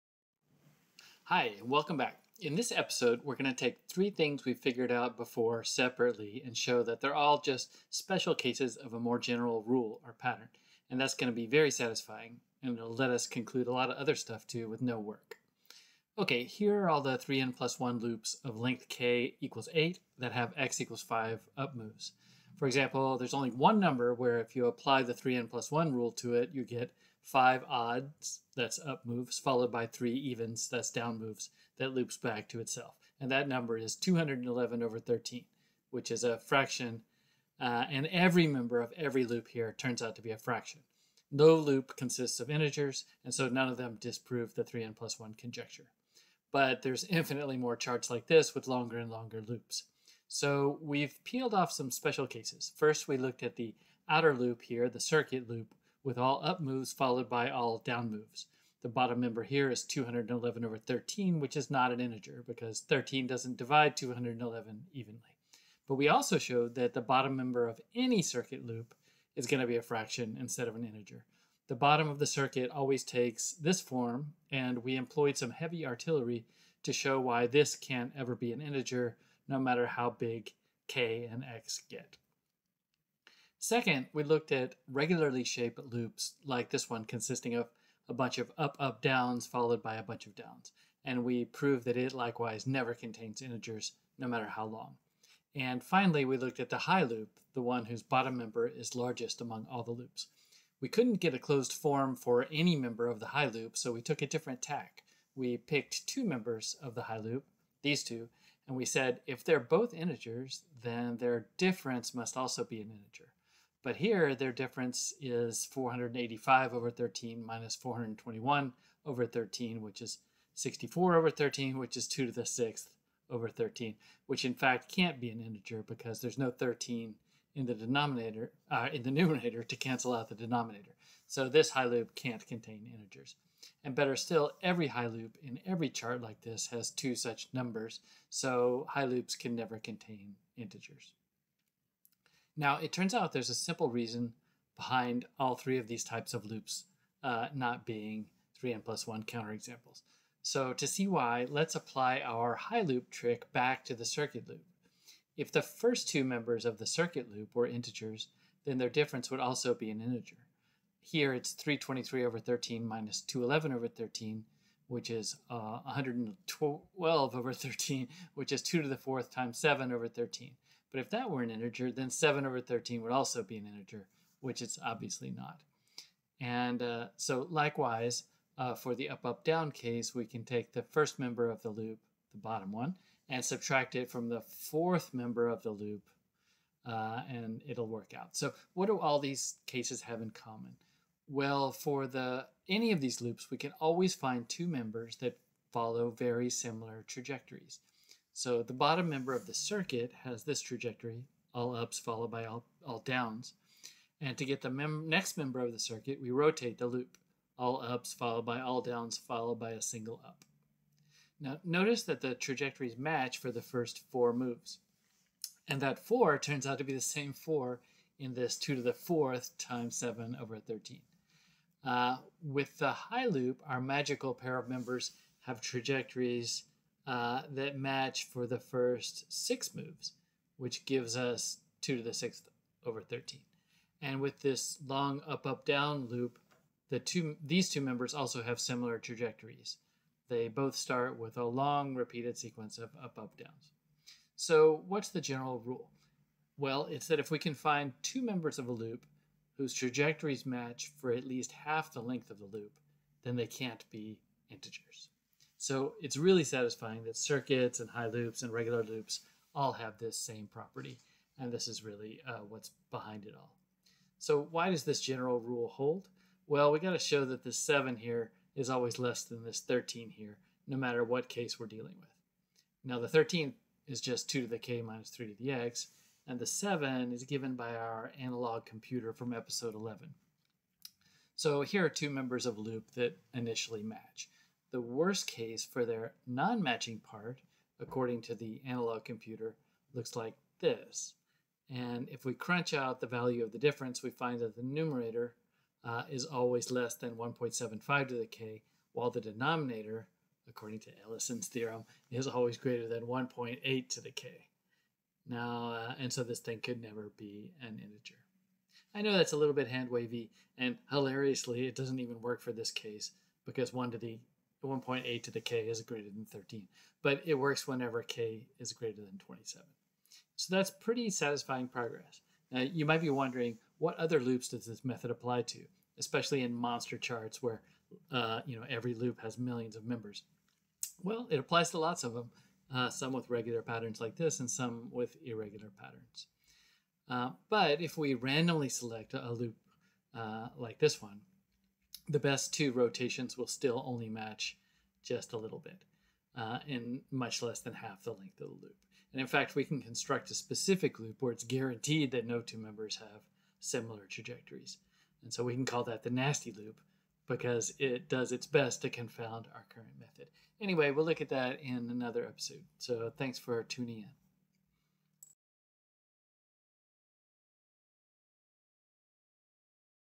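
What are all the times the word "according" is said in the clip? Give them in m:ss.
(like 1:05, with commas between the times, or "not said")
4:47, 5:00.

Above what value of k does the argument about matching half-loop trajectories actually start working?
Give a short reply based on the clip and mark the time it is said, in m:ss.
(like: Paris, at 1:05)
27, at 5:19.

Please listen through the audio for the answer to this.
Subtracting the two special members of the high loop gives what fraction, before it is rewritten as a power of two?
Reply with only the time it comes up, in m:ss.
2:00.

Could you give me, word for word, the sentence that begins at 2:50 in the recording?
But if that were an integer, then 7 over 13 would also be an integer, which it's obviously not.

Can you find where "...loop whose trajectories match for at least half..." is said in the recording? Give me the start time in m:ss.
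4:08.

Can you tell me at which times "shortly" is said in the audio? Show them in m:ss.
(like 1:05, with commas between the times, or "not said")
not said.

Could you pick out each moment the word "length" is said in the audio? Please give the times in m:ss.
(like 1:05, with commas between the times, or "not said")
0:18, 4:12, 5:48.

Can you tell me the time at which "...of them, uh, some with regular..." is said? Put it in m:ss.
5:32.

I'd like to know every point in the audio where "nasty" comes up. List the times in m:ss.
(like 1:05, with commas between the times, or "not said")
5:56.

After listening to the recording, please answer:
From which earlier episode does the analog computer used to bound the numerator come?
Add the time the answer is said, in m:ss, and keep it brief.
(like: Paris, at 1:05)
Episode 11, at 4:39.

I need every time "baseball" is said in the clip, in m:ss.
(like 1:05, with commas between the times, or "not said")
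not said.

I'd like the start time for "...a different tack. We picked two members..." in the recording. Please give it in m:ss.
1:44.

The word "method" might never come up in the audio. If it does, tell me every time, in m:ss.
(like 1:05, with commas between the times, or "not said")
5:24, 5:59.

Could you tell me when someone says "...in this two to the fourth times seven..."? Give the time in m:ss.
3:38.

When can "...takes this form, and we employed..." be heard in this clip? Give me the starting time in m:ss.
1:13.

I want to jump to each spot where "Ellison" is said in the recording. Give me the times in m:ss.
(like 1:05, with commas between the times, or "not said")
5:01.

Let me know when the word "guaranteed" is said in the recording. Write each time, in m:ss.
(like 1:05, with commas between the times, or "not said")
5:51.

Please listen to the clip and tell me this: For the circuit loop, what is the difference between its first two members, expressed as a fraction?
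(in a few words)
112/13.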